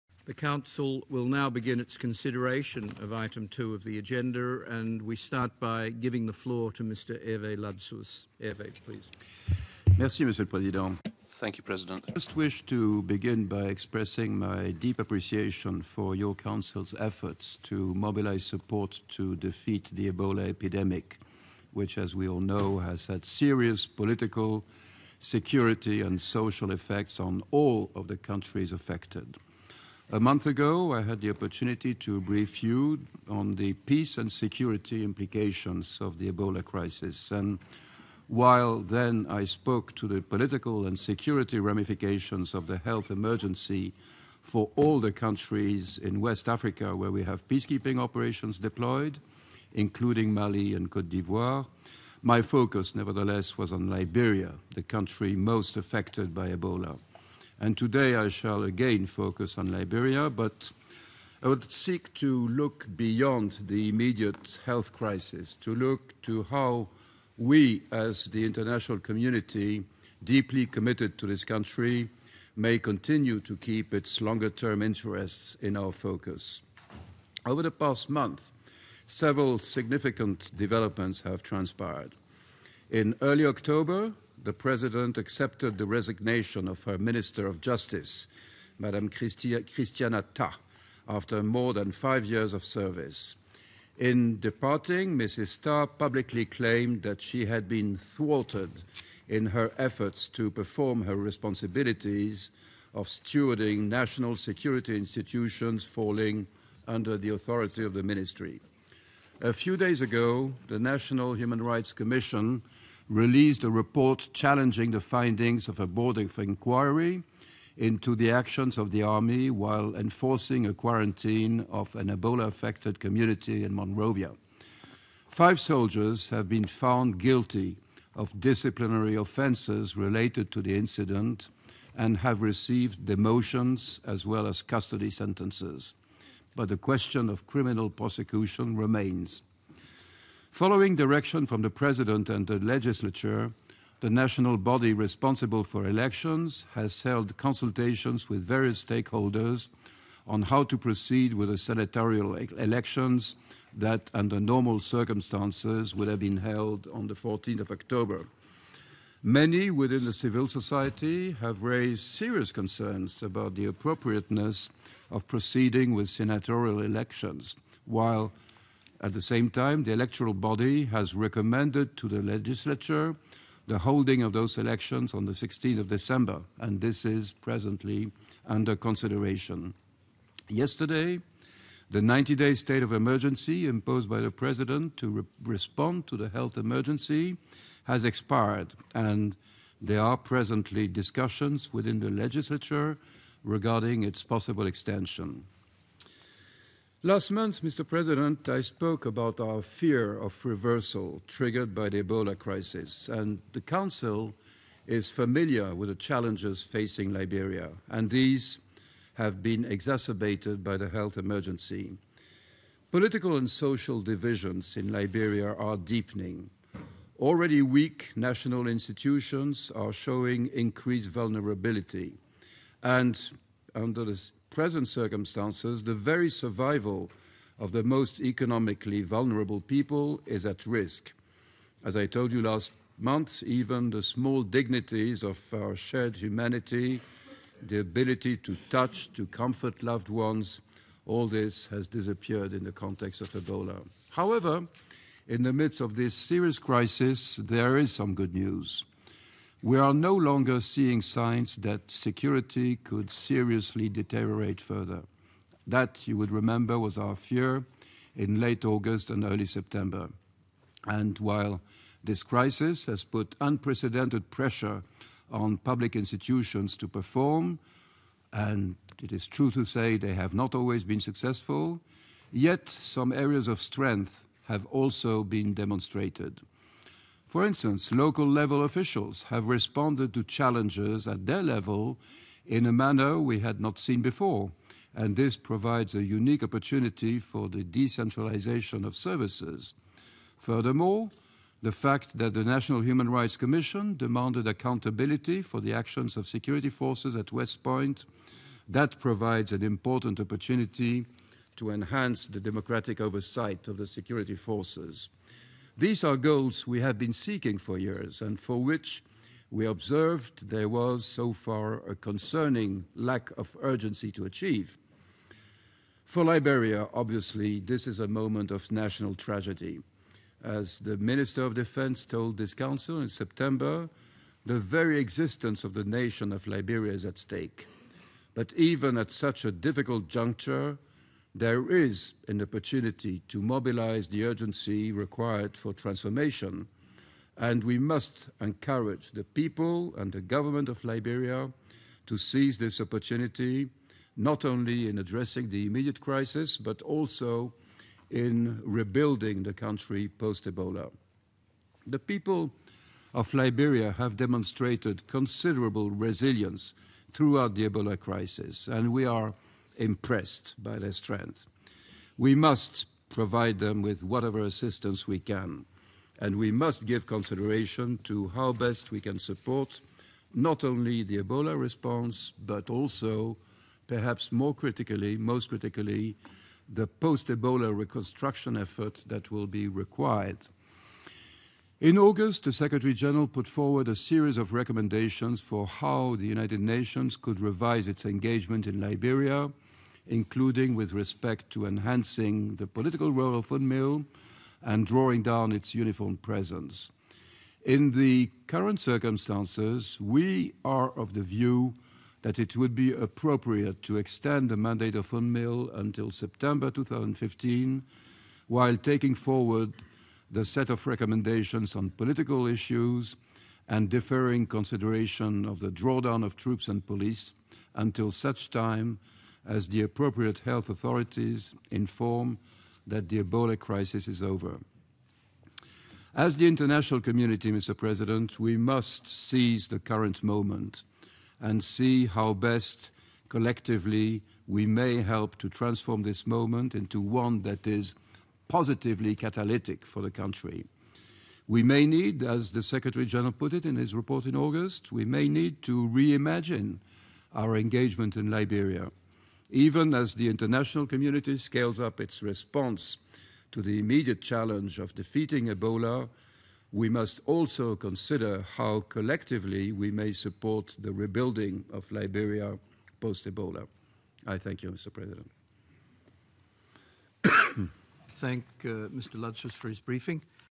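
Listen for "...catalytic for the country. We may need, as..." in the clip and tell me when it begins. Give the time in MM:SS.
07:19.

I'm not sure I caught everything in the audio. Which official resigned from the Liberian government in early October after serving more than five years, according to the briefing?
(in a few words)
Christiana Tah.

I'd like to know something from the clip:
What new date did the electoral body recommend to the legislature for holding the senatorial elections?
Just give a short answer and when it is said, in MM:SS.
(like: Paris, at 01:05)
16 December, at 02:55.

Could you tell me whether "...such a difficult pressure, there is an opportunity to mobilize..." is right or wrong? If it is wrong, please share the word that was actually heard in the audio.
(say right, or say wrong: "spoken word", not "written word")
wrong: "juncture", not "pressure".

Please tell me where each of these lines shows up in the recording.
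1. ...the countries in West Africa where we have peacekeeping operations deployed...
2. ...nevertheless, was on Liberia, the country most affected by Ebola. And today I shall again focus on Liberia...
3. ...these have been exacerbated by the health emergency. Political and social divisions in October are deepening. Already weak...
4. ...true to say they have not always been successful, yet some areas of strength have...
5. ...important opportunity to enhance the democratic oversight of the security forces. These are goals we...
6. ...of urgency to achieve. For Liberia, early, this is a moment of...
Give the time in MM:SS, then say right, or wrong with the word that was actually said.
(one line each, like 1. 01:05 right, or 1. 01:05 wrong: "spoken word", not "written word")
1. 00:44 right
2. 00:52 right
3. 03:28 wrong: "Liberia", not "October"
4. 04:29 right
5. 04:59 right
6. 05:13 wrong: "obviously", not "early".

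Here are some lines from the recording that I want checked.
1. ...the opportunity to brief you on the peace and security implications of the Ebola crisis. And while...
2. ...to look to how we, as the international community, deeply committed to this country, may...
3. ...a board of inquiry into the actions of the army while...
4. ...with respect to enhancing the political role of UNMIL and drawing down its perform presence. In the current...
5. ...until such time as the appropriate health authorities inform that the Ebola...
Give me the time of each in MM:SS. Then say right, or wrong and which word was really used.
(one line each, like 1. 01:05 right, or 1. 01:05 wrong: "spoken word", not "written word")
1. 00:31 right
2. 01:05 right
3. 01:55 right
4. 06:30 wrong: "uniform", not "perform"
5. 06:57 right.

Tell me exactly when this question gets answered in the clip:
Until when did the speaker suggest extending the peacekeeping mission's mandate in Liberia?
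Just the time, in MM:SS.
06:46.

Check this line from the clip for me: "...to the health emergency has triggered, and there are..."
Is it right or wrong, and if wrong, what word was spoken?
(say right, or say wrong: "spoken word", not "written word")
wrong: "expired", not "triggered".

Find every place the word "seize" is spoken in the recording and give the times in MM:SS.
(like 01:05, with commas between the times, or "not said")
05:42, 07:09.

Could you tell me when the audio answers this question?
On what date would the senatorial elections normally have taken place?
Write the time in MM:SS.
02:37.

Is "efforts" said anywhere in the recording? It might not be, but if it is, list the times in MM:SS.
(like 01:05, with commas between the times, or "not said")
00:16, 01:39, 06:18.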